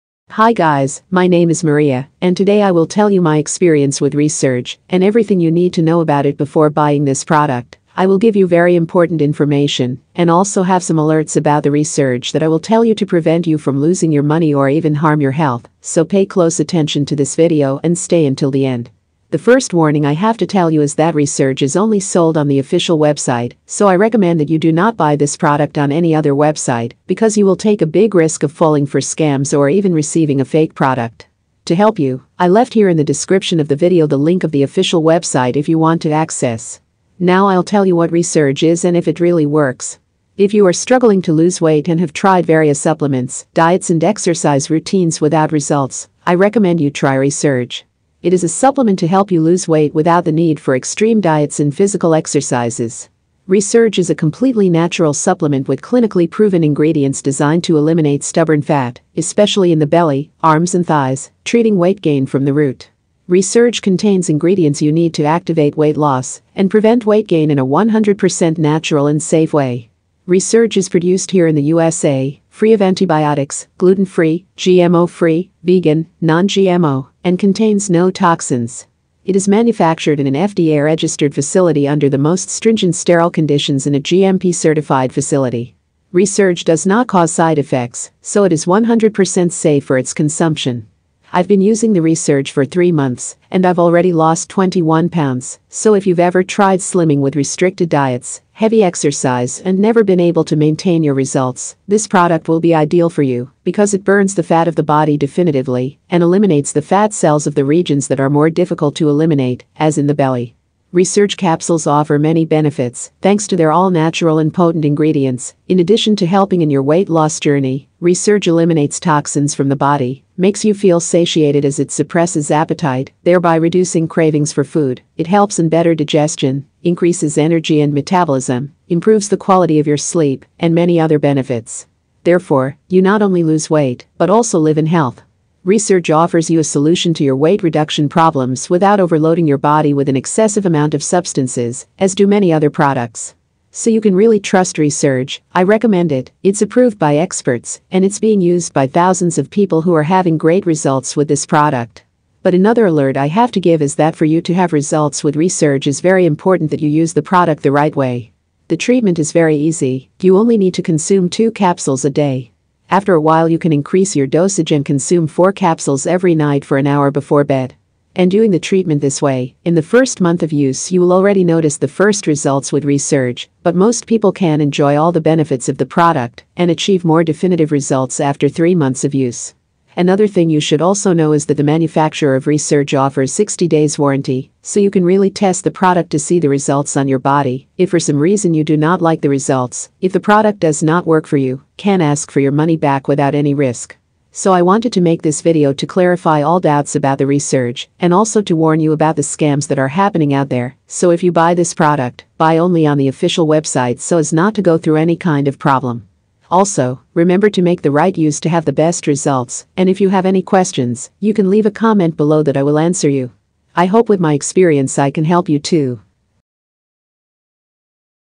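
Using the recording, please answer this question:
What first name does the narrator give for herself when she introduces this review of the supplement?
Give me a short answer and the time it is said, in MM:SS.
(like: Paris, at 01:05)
Maria, at 00:01.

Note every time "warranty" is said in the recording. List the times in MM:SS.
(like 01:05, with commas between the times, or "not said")
03:03.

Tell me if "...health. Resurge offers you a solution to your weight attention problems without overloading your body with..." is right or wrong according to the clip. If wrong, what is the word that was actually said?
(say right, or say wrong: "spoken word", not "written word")
wrong: "reduction", not "attention".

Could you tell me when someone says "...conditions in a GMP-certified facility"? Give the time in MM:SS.
01:23.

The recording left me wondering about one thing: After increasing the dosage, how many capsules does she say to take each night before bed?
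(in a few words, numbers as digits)
4.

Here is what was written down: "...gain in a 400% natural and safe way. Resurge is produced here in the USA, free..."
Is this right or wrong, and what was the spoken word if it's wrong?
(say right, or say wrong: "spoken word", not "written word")
wrong: "100", not "400".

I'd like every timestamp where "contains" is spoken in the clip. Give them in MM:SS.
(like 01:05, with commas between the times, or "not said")
01:03, 01:17.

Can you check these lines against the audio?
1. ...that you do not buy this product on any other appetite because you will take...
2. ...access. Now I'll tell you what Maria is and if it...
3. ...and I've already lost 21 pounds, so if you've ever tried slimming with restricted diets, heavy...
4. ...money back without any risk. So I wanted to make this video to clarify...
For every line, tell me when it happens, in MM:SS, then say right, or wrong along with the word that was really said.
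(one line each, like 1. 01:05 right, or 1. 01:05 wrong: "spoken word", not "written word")
1. 00:24 wrong: "website", not "appetite"
2. 00:36 wrong: "Resurge", not "Maria"
3. 01:33 right
4. 03:12 right.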